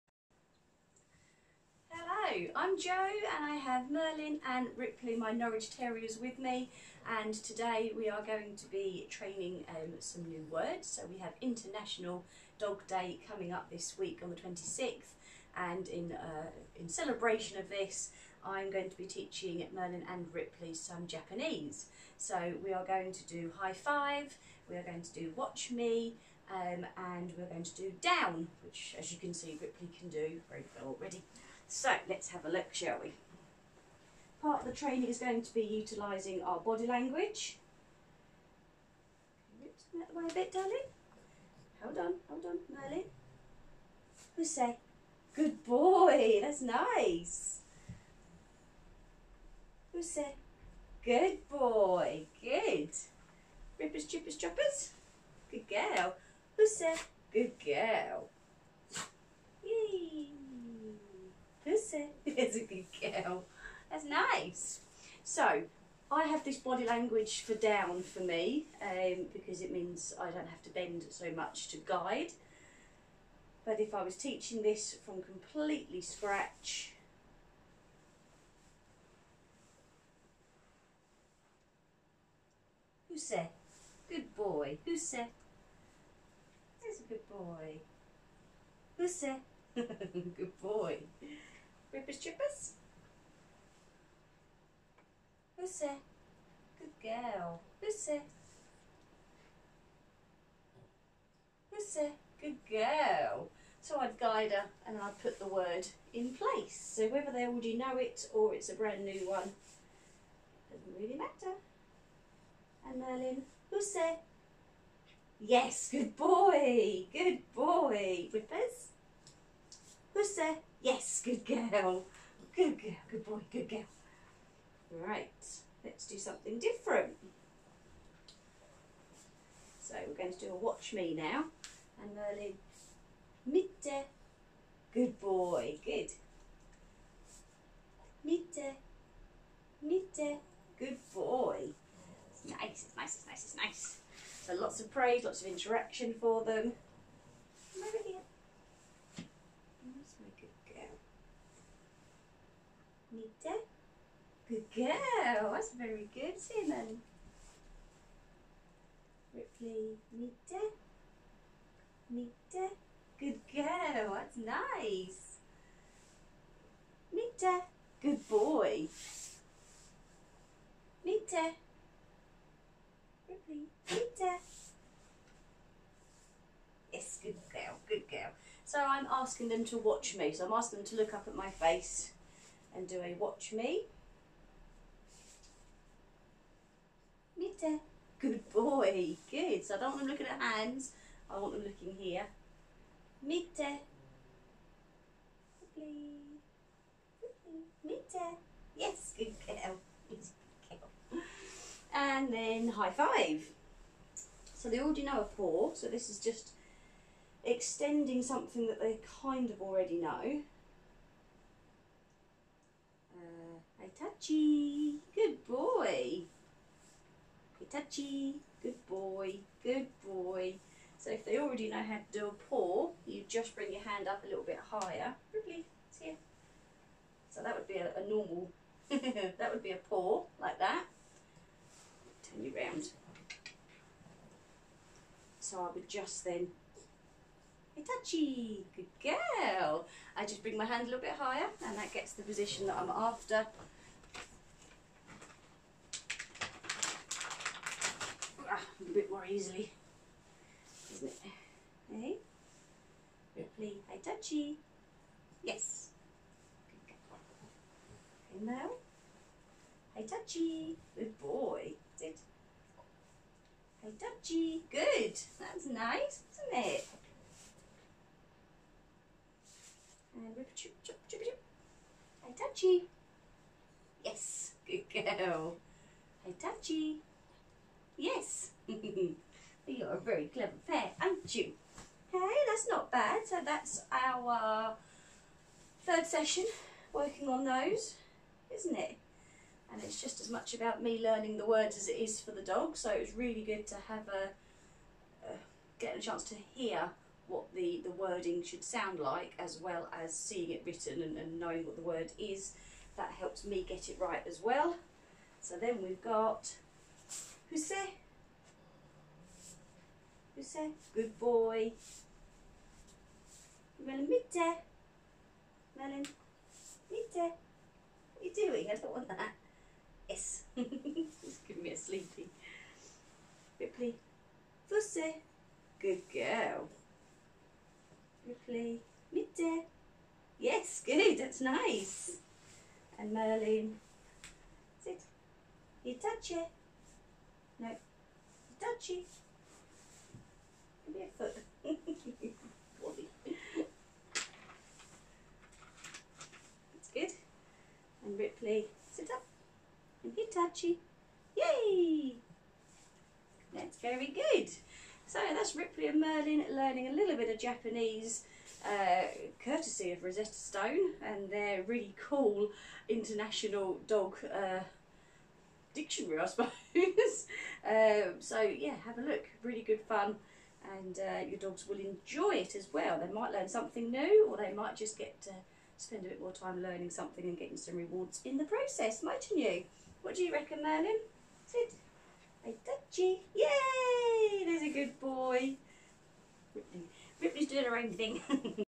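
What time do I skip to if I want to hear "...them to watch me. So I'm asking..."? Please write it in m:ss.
2:59.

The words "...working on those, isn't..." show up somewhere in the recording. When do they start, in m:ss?
4:46.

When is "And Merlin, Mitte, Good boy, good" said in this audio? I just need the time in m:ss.
2:12.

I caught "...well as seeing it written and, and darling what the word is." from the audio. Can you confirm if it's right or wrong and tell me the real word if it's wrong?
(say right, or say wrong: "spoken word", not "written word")
wrong: "knowing", not "darling".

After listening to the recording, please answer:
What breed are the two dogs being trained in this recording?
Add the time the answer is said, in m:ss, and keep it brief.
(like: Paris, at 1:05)
Norwich Terriers, at 0:05.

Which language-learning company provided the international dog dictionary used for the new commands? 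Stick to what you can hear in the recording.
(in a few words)
Rosetta Stone.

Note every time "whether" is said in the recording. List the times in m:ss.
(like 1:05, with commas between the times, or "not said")
1:47.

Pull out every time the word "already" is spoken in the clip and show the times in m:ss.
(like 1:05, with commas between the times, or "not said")
0:30, 1:47, 3:24, 3:29, 3:41.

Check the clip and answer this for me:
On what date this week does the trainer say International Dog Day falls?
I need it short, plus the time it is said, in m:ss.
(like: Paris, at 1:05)
26th, at 0:14.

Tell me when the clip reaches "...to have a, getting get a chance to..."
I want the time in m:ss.
4:53.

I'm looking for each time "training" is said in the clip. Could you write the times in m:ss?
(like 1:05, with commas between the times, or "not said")
0:09, 0:34.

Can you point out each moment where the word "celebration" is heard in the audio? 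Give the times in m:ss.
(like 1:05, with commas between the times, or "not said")
0:16.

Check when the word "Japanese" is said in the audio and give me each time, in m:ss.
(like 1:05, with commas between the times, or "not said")
0:21, 5:57.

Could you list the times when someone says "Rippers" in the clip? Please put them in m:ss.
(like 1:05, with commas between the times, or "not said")
0:53, 1:31, 1:58.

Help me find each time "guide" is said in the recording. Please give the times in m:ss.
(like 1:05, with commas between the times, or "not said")
1:11, 1:44.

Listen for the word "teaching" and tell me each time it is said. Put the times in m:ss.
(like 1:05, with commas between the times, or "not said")
0:19, 1:14.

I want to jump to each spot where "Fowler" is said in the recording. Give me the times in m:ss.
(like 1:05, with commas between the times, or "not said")
not said.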